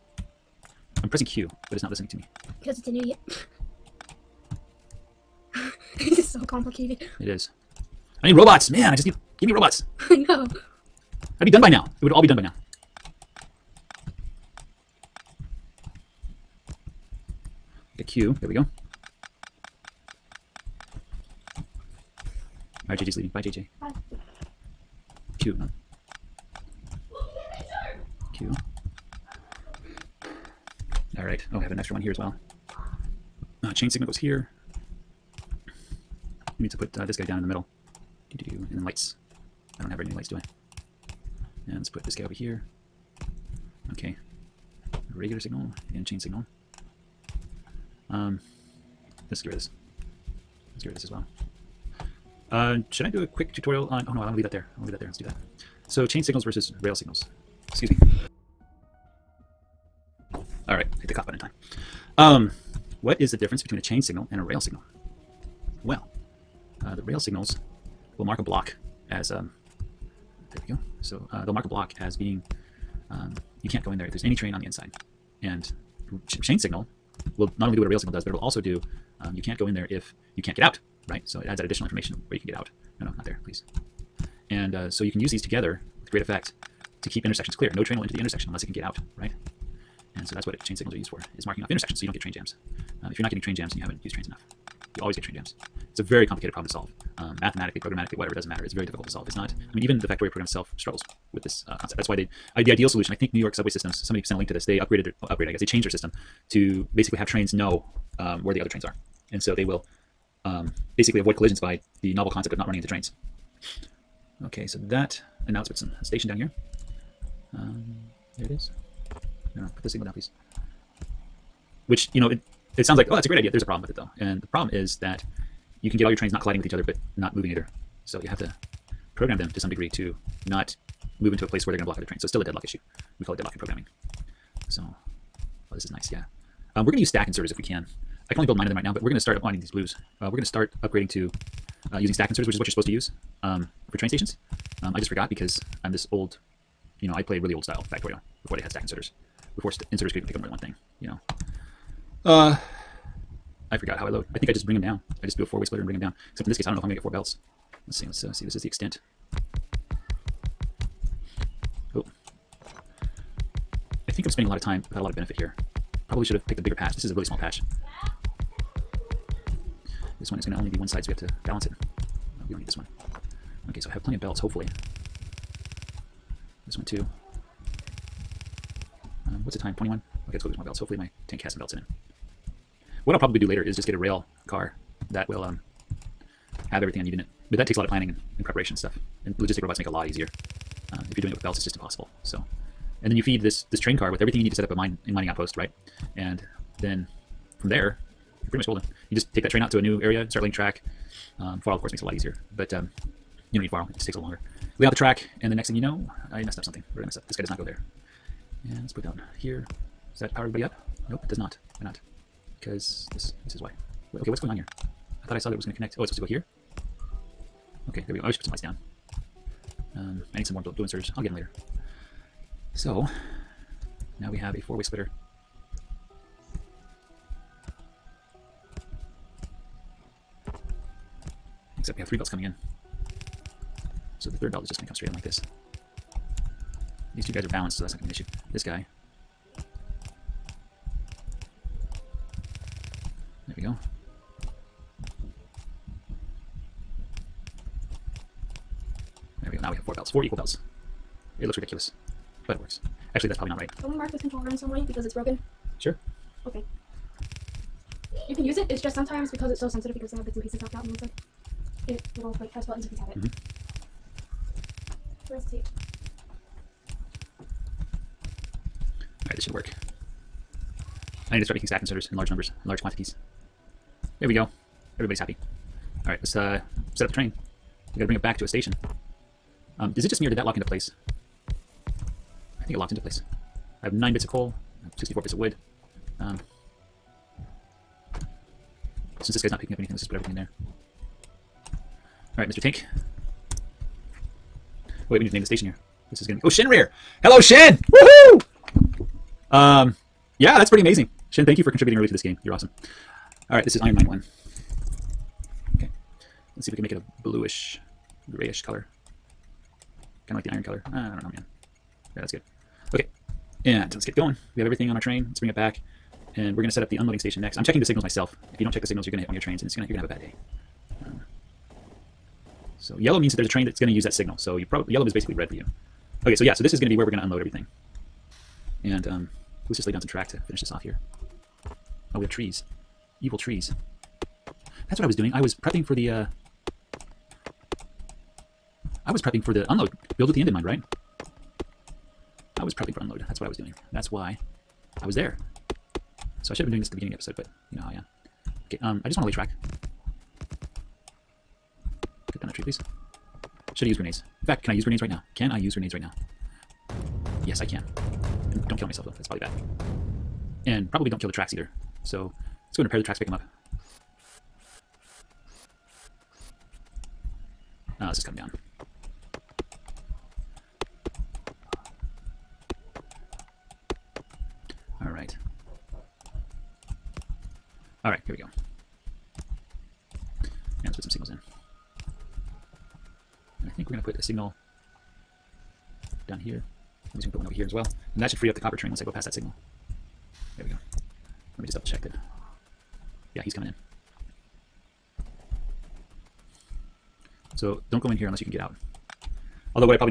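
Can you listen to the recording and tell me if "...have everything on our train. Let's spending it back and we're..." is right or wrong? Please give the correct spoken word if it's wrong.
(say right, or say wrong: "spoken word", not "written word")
wrong: "bring", not "spending".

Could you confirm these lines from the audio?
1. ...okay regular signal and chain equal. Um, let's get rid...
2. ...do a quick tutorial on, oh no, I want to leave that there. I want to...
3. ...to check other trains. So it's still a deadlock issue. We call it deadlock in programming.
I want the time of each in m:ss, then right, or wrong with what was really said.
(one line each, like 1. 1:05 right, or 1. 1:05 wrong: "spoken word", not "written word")
1. 0:43 wrong: "signal", not "equal"
2. 0:53 right
3. 2:11 wrong: "block", not "check".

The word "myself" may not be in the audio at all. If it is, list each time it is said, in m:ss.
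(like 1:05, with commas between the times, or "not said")
5:18, 5:58.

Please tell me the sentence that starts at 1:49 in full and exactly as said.
And so they will um, basically avoid collisions by the novel concept of not running into trains.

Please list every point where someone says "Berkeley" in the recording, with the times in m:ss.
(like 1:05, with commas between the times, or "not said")
not said.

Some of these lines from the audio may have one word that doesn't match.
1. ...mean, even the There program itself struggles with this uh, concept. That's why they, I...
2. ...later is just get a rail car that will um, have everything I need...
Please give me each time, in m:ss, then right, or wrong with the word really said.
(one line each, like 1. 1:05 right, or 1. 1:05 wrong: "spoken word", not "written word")
1. 1:39 wrong: "Factorio", not "There"
2. 3:03 right.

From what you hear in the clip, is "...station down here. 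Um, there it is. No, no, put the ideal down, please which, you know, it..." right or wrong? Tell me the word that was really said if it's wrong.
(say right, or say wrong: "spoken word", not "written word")
wrong: "signal", not "ideal".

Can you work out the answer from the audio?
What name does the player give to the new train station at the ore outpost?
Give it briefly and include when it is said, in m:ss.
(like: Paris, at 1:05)
Iron Mine 1, at 5:03.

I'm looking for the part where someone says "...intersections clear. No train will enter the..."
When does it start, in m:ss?
1:27.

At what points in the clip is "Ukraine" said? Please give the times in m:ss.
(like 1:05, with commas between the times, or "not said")
not said.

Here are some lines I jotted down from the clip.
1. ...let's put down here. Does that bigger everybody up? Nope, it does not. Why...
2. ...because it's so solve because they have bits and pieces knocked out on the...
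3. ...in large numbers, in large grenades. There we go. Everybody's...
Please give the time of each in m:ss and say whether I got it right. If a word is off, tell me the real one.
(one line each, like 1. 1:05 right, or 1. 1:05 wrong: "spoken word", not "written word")
1. 3:28 wrong: "power", not "bigger"
2. 4:19 wrong: "sensitive", not "solve"
3. 4:32 wrong: "quantities", not "grenades".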